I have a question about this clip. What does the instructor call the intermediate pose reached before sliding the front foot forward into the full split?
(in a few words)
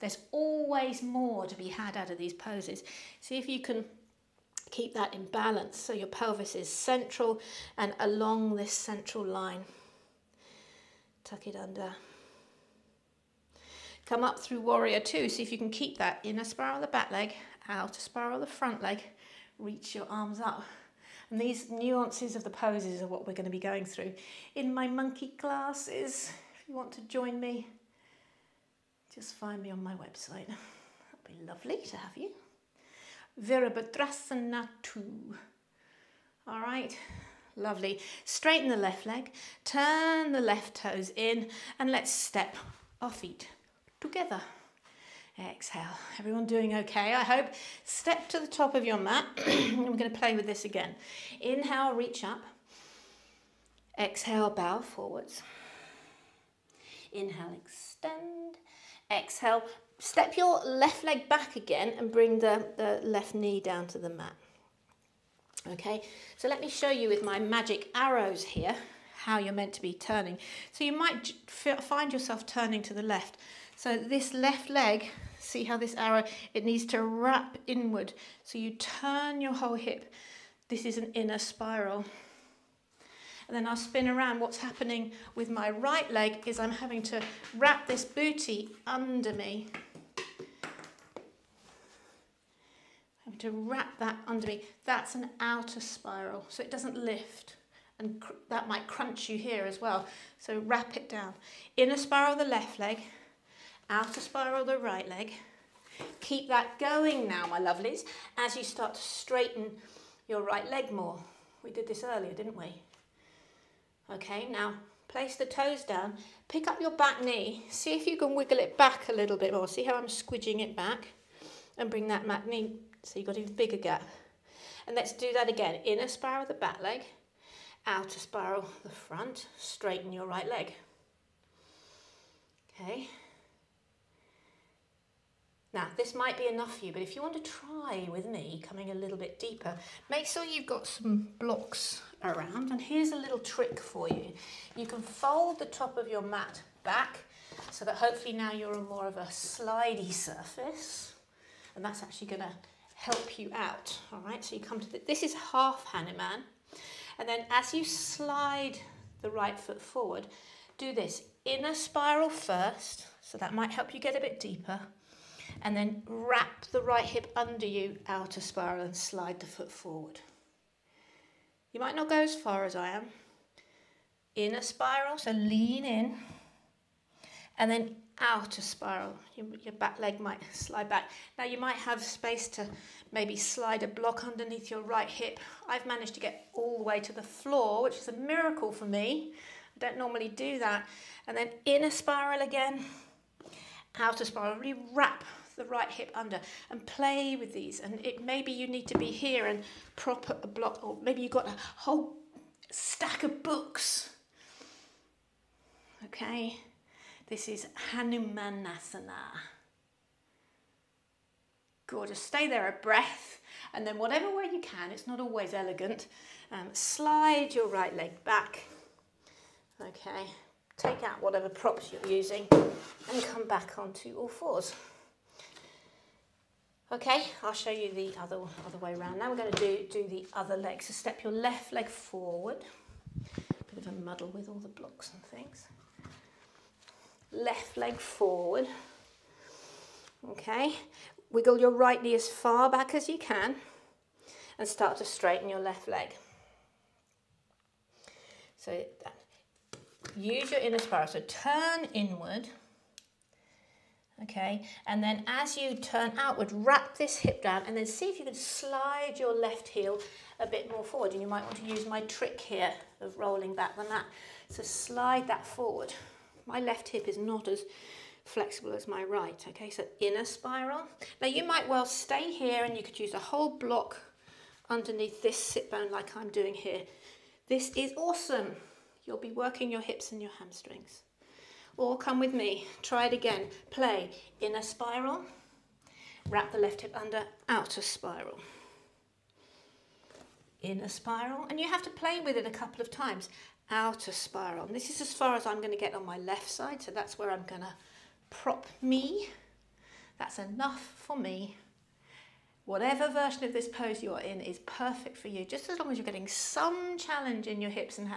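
half Hanuman.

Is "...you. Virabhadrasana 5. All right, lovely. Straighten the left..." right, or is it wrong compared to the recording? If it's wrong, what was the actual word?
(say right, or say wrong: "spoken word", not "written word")
wrong: "2", not "5".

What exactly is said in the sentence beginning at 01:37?
And that might crunch you here as well.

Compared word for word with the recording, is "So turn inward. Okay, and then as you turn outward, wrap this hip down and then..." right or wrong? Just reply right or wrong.
right.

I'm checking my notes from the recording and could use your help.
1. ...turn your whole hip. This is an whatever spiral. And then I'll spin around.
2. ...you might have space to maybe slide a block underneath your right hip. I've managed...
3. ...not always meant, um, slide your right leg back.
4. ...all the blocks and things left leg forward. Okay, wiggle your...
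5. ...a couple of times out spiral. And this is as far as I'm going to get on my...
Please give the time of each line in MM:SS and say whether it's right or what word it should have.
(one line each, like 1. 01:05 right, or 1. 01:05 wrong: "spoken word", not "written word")
1. 01:18 wrong: "inner", not "whatever"
2. 03:01 right
3. 03:35 wrong: "elegant", not "meant"
4. 03:54 right
5. 04:52 right.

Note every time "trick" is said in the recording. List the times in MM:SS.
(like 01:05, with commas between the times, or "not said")
02:23, 04:22.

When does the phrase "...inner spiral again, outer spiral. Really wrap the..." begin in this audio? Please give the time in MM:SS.
03:11.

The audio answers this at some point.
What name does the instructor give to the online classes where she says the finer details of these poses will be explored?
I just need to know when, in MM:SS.
00:24.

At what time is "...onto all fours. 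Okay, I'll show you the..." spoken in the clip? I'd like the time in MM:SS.
03:43.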